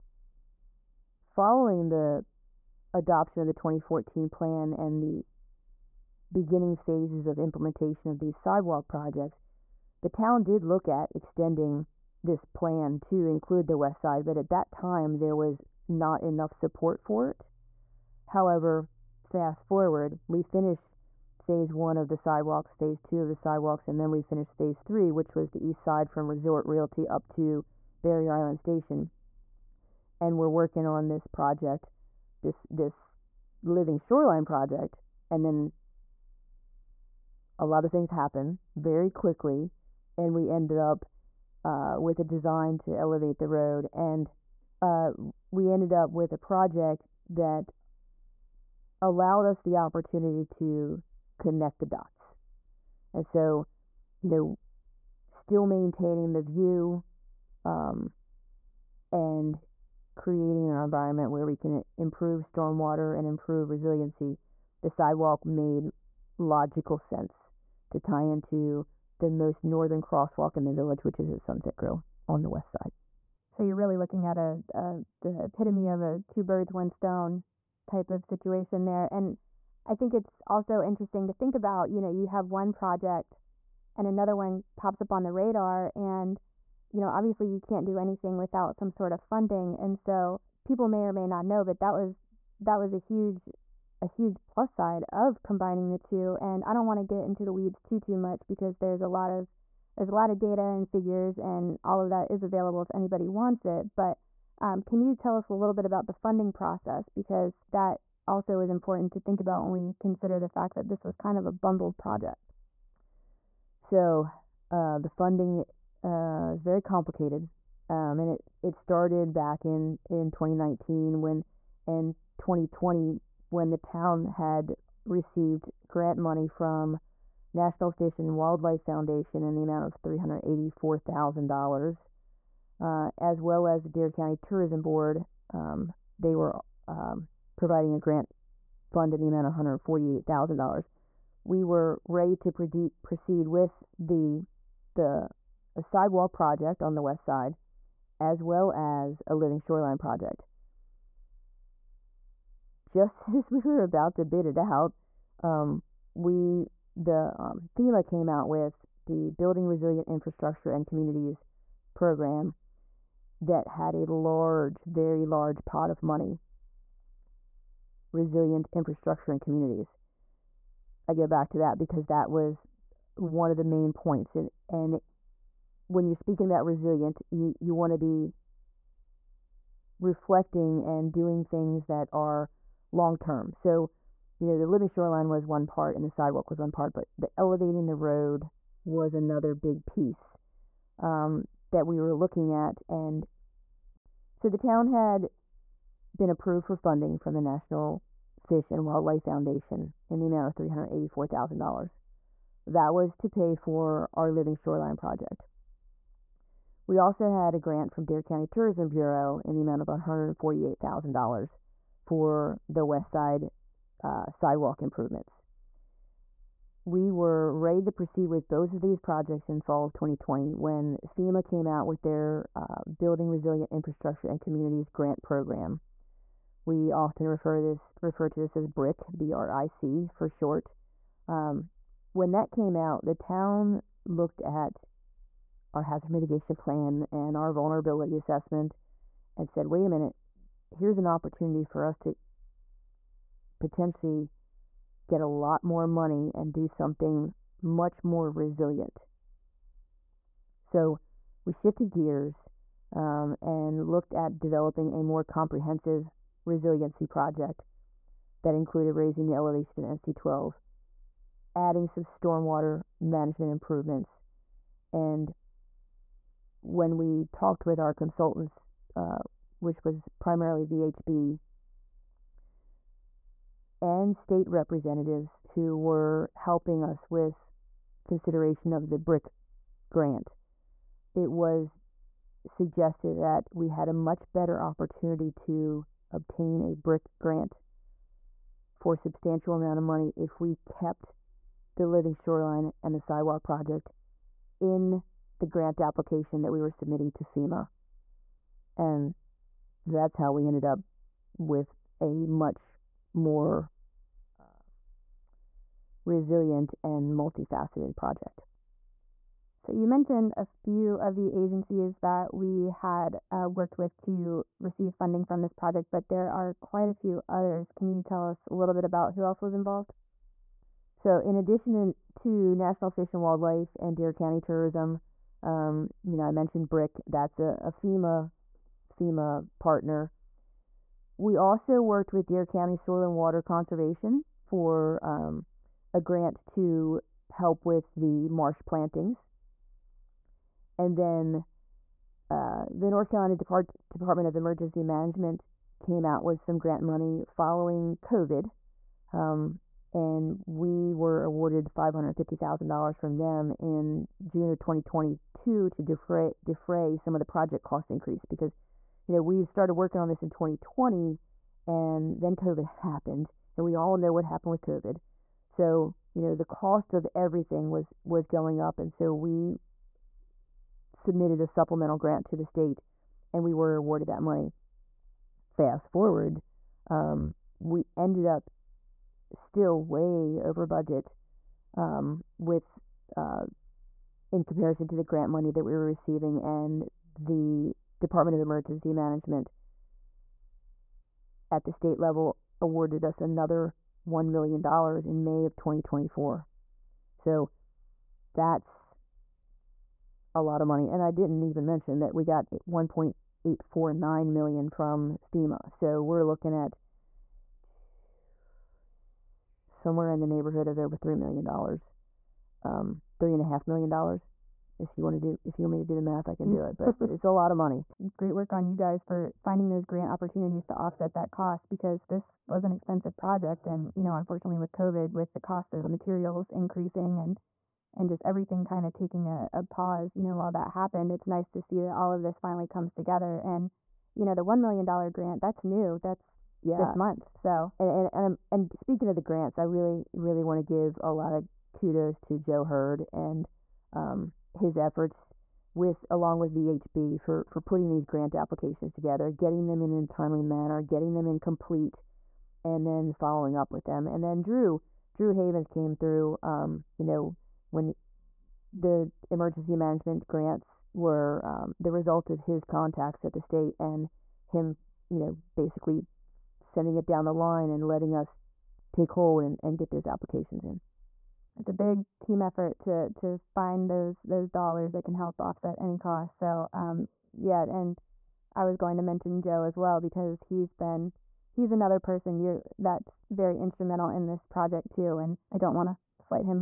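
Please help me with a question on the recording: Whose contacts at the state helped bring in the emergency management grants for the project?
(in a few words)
Drew Havens.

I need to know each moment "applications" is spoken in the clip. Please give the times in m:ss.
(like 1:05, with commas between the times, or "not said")
4:55, 7:28, 7:50.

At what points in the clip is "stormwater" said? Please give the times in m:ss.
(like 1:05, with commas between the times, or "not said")
1:02, 4:22.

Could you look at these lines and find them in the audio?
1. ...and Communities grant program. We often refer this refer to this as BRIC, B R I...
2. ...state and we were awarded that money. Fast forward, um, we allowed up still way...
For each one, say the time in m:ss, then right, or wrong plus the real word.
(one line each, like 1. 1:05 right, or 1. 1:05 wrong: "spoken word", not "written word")
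1. 3:44 right
2. 6:12 wrong: "ended", not "allowed".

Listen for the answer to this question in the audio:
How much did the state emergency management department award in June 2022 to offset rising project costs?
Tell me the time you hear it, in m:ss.
5:51.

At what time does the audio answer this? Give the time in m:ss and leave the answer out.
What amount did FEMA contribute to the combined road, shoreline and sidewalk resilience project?
6:42.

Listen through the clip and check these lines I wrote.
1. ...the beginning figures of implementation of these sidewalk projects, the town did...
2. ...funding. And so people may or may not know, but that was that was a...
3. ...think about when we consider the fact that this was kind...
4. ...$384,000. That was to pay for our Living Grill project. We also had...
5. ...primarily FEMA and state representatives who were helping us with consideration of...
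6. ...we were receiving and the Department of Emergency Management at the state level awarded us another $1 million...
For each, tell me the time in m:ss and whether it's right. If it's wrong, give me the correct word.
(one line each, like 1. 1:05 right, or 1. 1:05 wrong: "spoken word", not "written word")
1. 0:05 wrong: "phases", not "figures"
2. 1:29 right
3. 1:49 right
4. 3:20 wrong: "Shoreline", not "Grill"
5. 4:30 wrong: "VHB", not "FEMA"
6. 6:25 right.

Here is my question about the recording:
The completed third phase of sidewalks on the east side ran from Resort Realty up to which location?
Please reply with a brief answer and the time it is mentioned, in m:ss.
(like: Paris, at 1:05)
Barrier Island Station, at 0:28.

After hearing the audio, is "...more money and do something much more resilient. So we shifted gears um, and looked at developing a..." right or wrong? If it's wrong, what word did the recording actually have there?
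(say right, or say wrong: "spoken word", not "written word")
right.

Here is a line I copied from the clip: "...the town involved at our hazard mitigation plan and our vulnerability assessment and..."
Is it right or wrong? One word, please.
wrong.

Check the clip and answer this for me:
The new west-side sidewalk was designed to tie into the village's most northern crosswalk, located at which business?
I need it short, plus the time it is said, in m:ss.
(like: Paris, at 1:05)
Sunset Grill, at 1:11.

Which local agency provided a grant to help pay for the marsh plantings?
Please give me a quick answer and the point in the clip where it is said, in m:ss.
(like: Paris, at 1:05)
Dare County Soil and Water Conservation, at 5:32.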